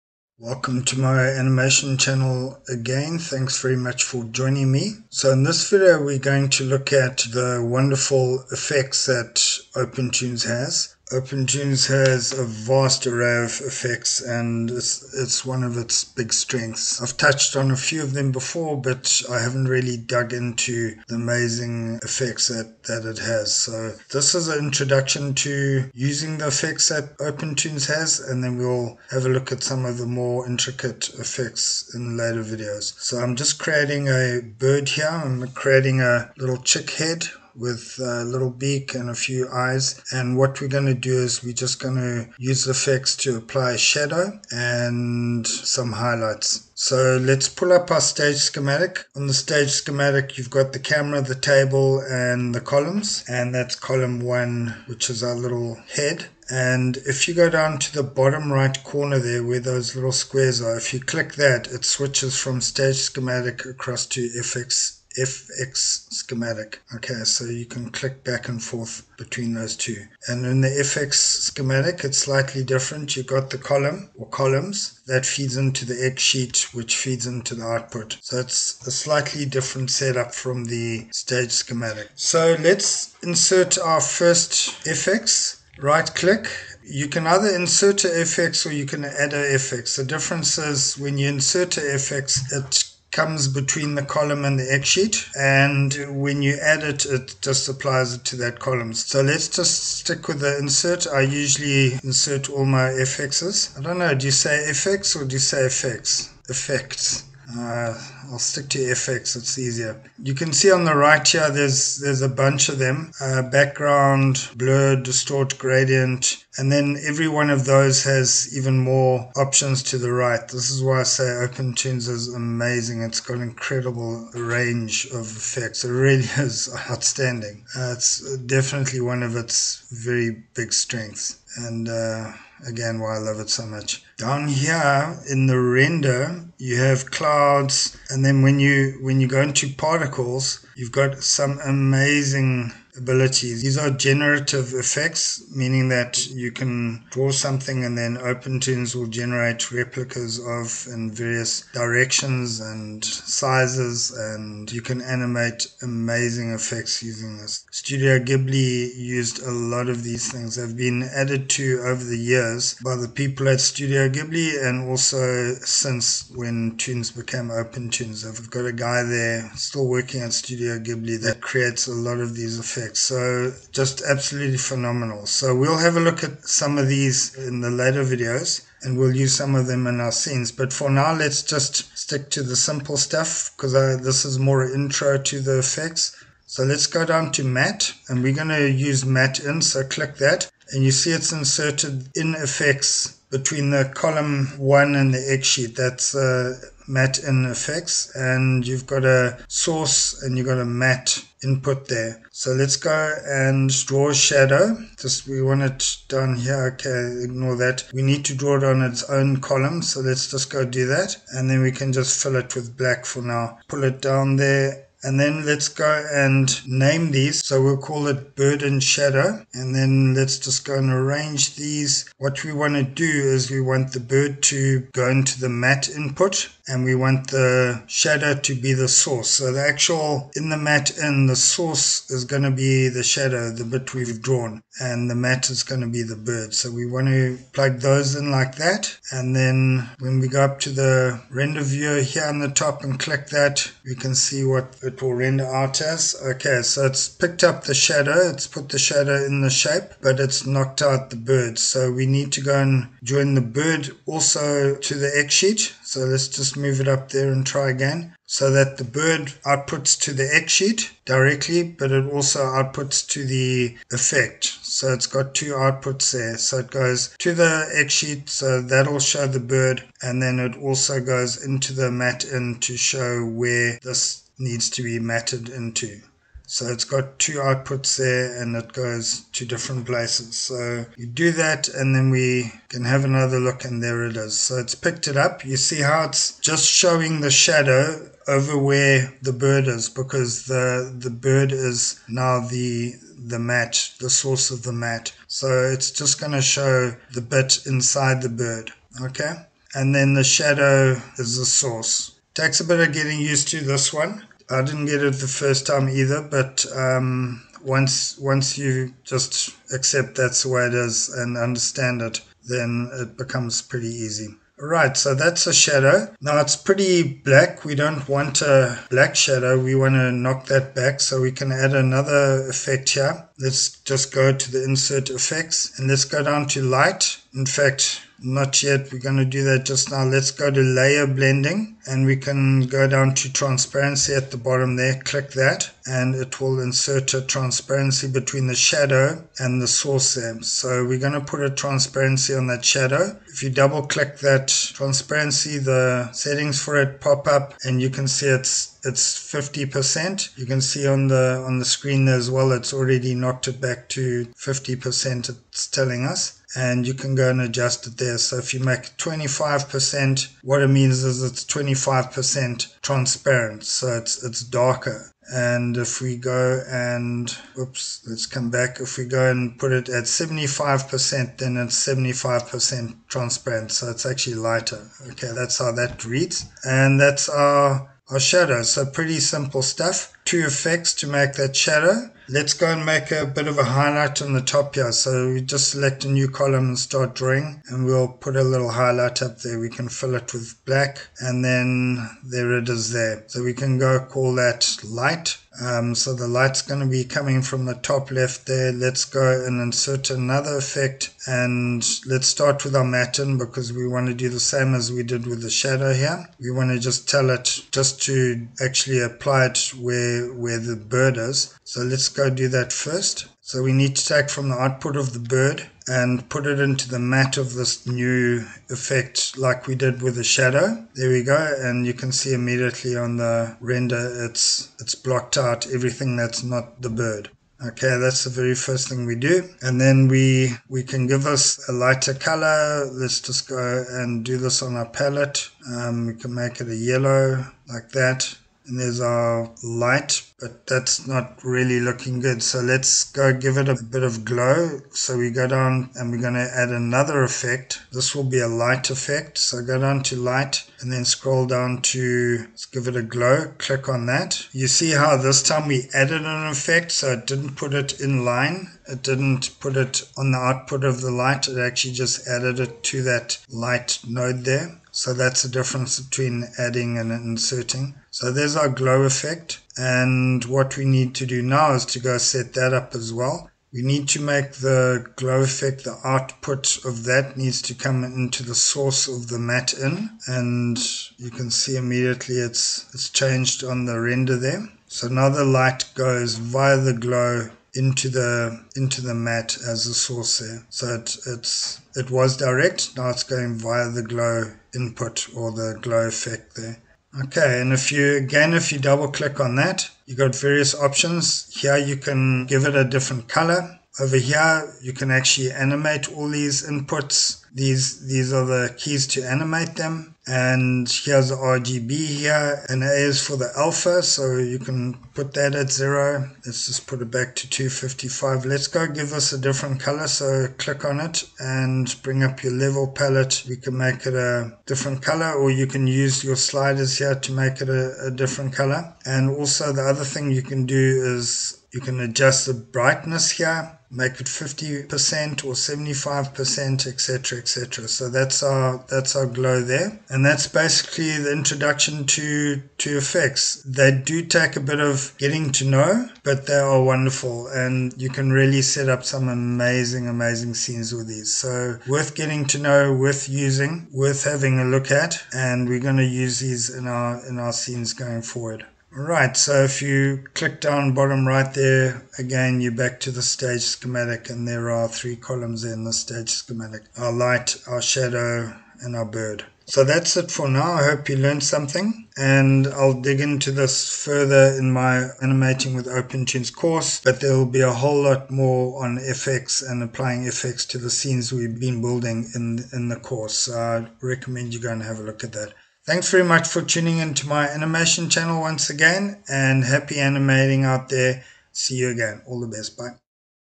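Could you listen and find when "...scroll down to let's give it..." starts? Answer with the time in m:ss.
7:31.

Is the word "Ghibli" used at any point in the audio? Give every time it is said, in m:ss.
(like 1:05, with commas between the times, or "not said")
2:38, 2:44, 2:50.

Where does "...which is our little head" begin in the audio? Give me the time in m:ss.
0:54.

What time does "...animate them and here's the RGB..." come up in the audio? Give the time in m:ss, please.
8:29.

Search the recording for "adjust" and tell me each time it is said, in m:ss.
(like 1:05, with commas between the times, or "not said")
5:57, 8:52.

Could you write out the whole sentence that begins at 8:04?
So now the light goes via the glow into the into the matte as the source there.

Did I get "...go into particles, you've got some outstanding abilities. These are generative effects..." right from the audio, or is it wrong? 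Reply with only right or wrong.
wrong.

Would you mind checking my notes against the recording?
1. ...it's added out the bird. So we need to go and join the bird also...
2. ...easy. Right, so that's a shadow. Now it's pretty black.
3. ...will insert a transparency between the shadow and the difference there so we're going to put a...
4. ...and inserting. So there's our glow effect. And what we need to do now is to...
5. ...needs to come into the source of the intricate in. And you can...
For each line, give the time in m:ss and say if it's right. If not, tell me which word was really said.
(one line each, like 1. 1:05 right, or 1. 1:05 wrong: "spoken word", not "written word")
1. 4:10 wrong: "knocked", not "added"
2. 5:13 right
3. 5:36 wrong: "source", not "difference"
4. 7:46 right
5. 7:57 wrong: "matte", not "intricate".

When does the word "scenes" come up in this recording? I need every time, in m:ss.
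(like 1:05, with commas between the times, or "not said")
3:00, 9:10, 9:17, 9:40.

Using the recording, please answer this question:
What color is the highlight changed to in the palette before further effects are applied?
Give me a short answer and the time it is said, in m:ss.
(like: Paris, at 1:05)
Yellow, at 7:16.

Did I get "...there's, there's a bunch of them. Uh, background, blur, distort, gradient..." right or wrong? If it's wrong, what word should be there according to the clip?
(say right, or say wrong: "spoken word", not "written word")
right.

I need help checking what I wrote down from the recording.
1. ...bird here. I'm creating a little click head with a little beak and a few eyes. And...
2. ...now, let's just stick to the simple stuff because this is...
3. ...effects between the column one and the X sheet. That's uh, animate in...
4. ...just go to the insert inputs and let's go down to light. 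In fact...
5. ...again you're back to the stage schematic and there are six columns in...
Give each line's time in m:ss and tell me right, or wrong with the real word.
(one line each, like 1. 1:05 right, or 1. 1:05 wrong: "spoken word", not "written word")
1. 0:34 wrong: "chick", not "click"
2. 3:00 right
3. 3:12 wrong: "matte", not "animate"
4. 5:23 wrong: "effects", not "inputs"
5. 9:22 wrong: "three", not "six".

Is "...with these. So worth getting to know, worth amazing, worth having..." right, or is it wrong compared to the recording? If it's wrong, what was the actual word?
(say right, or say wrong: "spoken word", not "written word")
wrong: "using", not "amazing".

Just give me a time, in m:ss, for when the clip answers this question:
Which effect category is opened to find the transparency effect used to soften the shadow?
5:30.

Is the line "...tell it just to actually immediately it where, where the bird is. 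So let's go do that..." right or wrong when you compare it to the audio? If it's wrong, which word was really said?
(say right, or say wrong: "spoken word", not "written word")
wrong: "apply", not "immediately".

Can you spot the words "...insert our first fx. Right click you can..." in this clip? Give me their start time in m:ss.
1:23.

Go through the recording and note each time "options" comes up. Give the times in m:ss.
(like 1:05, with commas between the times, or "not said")
1:59, 8:20.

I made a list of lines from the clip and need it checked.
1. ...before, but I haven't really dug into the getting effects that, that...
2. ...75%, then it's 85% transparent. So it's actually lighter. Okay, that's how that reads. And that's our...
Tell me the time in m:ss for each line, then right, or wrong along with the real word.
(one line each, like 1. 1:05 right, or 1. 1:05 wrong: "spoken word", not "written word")
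1. 0:18 wrong: "amazing", not "getting"
2. 6:10 wrong: "75", not "85".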